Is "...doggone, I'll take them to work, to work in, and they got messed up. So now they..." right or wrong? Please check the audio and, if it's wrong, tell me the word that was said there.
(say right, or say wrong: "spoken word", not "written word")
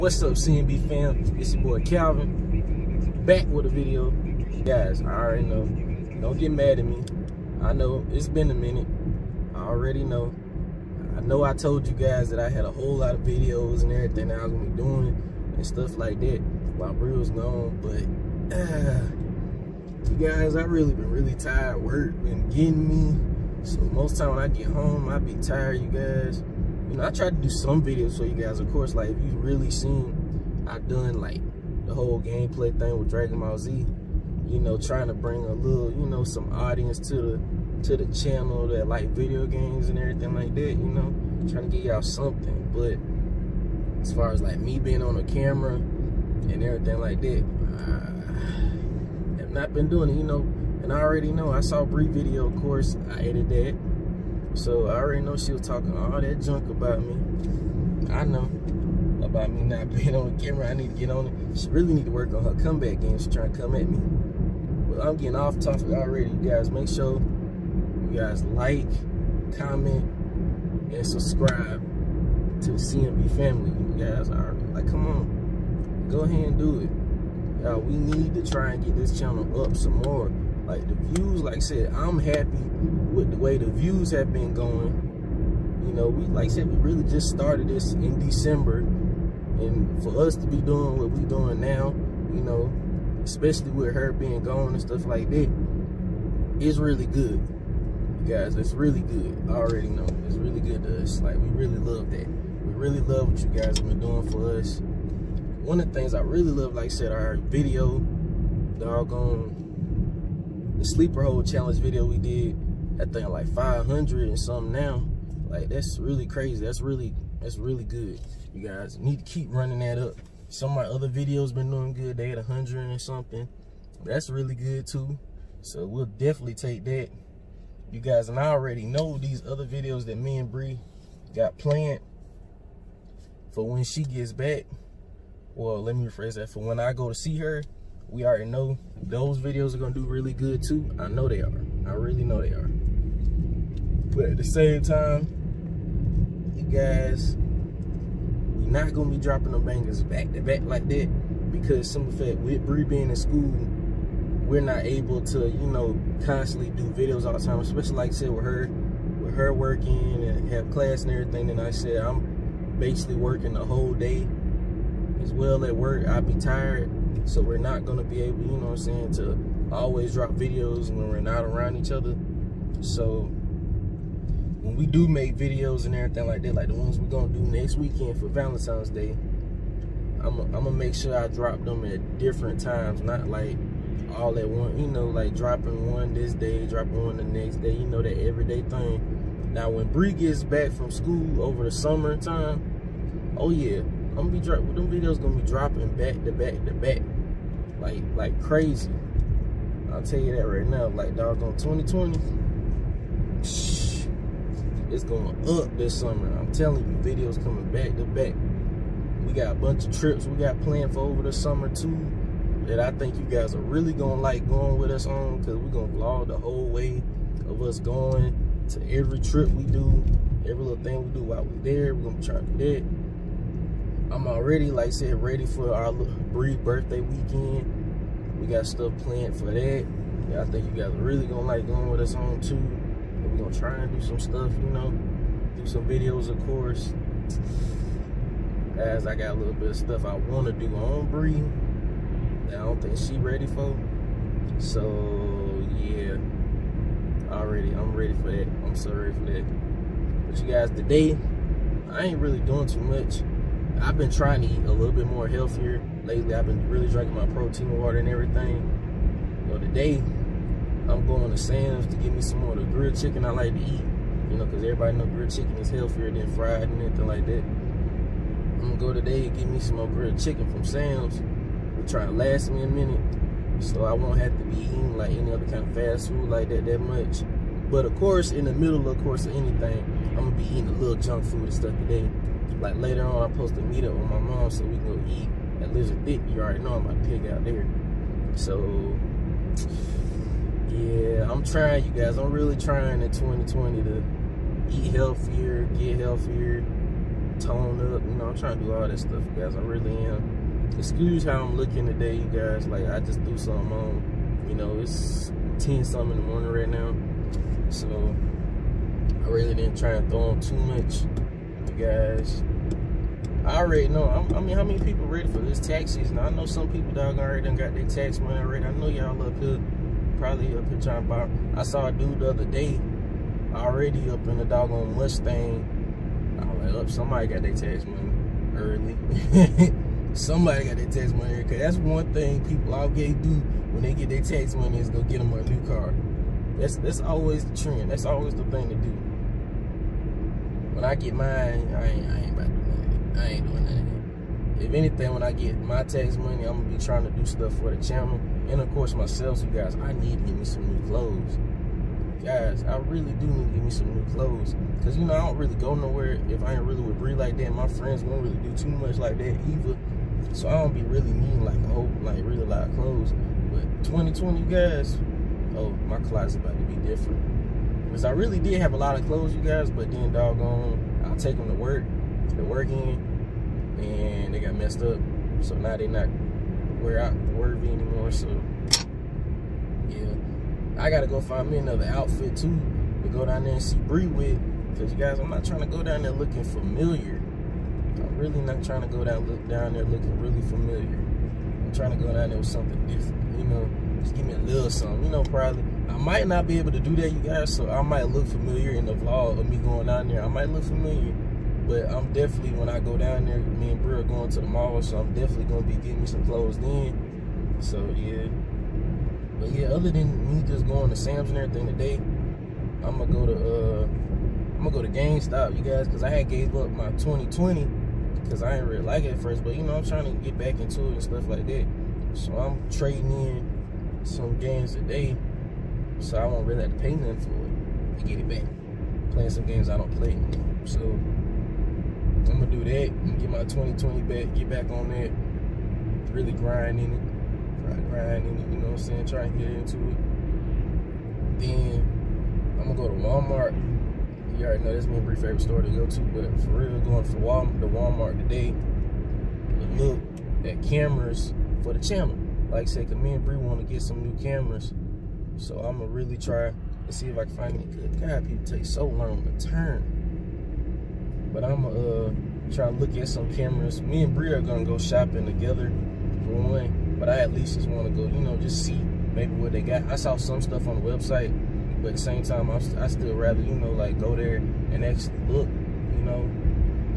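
right.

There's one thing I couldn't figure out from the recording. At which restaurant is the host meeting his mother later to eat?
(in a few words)
Lizard Thicket.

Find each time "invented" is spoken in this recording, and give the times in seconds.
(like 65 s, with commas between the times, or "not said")
not said.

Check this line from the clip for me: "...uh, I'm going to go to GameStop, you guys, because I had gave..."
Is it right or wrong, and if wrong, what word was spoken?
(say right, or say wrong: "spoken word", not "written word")
right.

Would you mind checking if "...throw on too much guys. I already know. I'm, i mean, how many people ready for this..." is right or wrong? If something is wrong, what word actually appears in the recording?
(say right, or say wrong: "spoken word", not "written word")
right.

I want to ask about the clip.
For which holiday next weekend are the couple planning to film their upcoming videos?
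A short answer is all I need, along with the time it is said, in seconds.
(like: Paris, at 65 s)
Valentine's Day, at 178 s.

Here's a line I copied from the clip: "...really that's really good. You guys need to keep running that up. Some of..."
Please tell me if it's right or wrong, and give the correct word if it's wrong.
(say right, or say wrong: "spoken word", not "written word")
right.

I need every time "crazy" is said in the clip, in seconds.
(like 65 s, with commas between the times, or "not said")
116 s, 198 s.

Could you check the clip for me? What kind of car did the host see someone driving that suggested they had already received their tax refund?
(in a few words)
Mustang.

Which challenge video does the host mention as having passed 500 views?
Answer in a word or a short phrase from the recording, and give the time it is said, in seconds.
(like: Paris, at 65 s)
sleeper hold challenge, at 110 s.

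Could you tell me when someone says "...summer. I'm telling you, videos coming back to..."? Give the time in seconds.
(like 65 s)
205 s.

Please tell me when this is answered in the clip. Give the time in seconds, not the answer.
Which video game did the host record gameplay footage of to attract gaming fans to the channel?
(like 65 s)
33 s.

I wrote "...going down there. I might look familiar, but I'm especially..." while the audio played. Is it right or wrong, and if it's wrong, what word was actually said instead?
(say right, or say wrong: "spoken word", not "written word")
wrong: "definitely", not "especially".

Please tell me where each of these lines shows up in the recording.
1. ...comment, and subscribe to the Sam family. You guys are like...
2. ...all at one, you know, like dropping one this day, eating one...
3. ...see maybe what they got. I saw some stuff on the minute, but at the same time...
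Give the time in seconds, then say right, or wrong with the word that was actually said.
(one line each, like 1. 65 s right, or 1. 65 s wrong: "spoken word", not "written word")
1. 69 s wrong: "CNB", not "Sam"
2. 184 s wrong: "dropping", not "eating"
3. 468 s wrong: "website", not "minute".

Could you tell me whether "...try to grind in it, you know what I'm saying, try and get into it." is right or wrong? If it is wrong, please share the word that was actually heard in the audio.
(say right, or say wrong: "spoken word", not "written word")
right.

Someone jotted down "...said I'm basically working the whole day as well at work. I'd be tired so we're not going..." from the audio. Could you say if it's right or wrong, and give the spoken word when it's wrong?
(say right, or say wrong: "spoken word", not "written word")
right.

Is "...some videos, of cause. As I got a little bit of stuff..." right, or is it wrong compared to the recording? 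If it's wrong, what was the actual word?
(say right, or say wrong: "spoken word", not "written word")
wrong: "course", not "cause".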